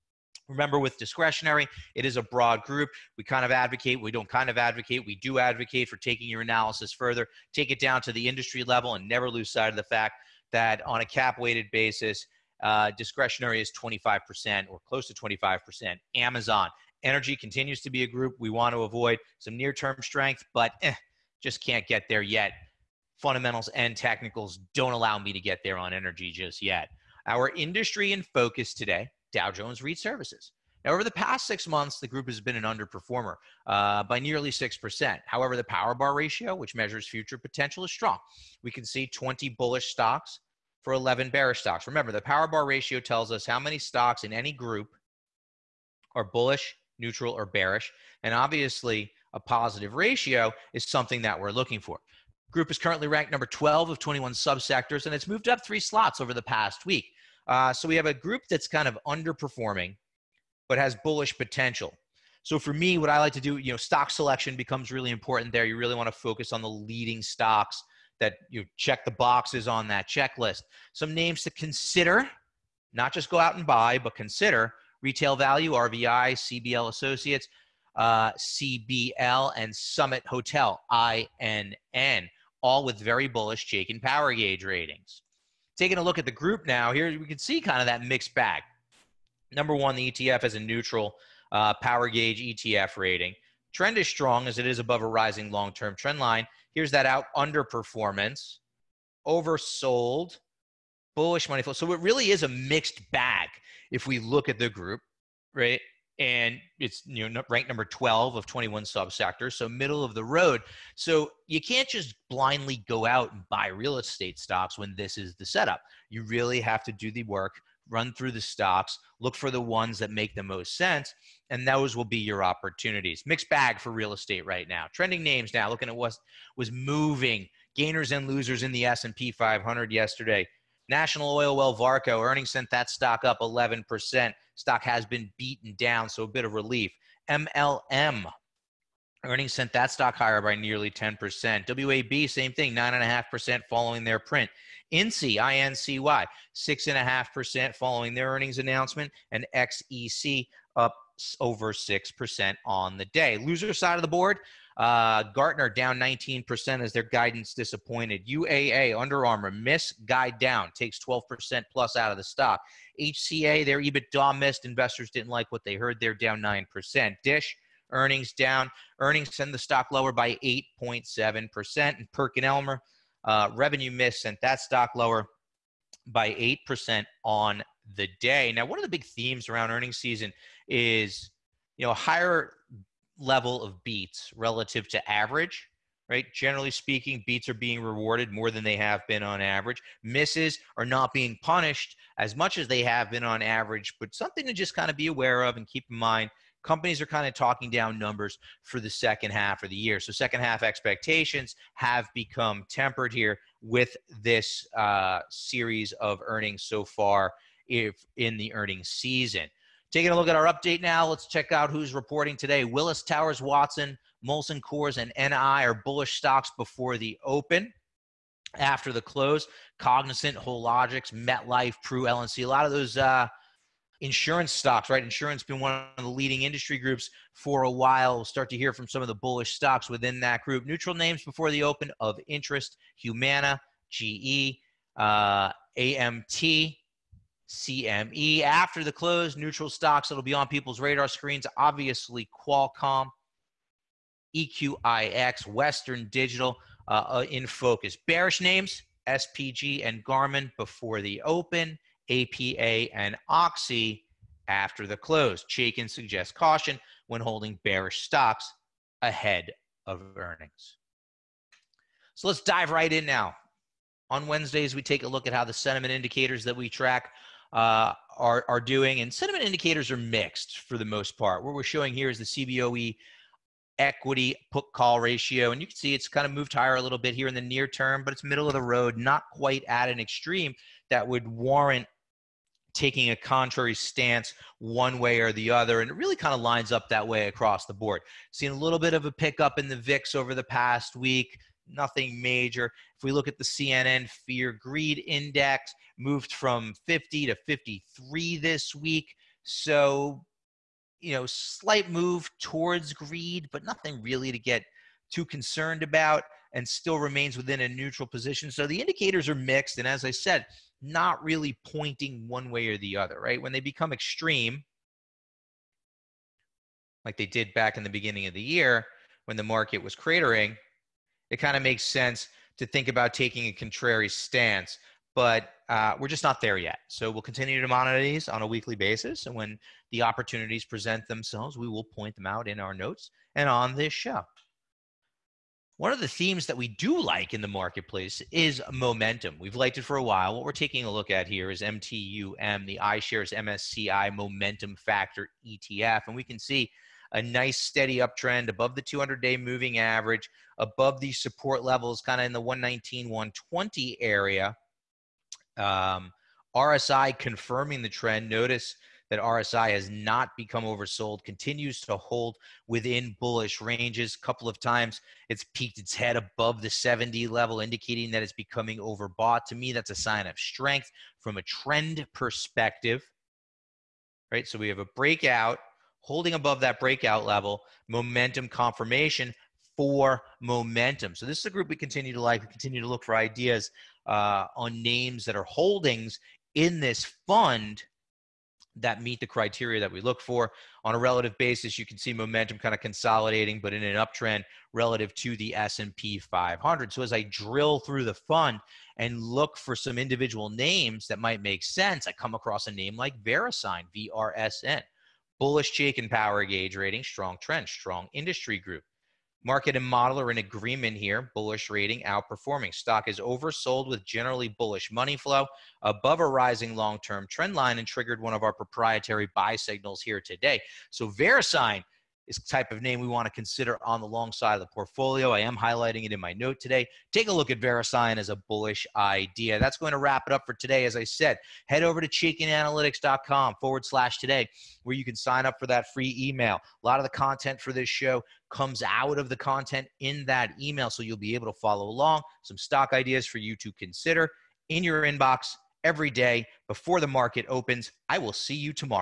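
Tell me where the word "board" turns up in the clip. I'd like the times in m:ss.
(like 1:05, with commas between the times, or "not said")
2:34, 4:47.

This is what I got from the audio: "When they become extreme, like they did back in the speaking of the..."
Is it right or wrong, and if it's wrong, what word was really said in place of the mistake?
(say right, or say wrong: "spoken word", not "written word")
wrong: "beginning", not "speaking".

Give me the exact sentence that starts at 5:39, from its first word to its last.
We've liked it for a while.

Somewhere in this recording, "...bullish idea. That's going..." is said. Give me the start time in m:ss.
7:08.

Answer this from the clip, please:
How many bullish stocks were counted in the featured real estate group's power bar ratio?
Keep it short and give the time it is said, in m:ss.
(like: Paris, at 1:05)
20, at 0:39.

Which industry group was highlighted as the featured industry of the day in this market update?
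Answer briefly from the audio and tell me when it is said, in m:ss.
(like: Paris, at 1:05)
Dow Jones REIT Services, at 0:29.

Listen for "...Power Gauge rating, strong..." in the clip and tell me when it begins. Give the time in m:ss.
6:46.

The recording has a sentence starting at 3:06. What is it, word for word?
Generally speaking, beats are being rewarded more than they have been on average.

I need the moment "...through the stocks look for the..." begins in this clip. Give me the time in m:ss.
1:58.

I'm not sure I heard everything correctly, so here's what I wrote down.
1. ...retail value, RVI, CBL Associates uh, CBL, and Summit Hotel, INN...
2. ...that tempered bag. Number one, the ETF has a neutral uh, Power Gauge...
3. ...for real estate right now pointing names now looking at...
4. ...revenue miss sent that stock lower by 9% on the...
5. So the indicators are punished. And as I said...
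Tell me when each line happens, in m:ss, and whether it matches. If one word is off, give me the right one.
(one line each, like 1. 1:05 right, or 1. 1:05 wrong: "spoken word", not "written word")
1. 1:15 right
2. 1:27 wrong: "mixed", not "tempered"
3. 2:03 wrong: "trending", not "pointing"
4. 2:53 wrong: "8", not "9"
5. 5:08 wrong: "mixed", not "punished".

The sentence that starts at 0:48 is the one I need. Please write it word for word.
And obviously, a positive ratio is something that we're looking for.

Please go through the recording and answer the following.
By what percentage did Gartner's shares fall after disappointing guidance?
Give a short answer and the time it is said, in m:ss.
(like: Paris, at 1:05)
19%, at 2:35.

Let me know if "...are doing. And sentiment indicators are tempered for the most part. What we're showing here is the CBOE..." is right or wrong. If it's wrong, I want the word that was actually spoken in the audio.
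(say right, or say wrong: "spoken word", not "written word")
wrong: "mixed", not "tempered".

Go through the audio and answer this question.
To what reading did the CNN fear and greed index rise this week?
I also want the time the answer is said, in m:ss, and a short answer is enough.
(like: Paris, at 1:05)
53, at 4:56.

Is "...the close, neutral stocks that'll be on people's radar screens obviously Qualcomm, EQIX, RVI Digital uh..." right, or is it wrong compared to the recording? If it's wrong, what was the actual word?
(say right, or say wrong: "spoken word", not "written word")
wrong: "Western", not "RVI".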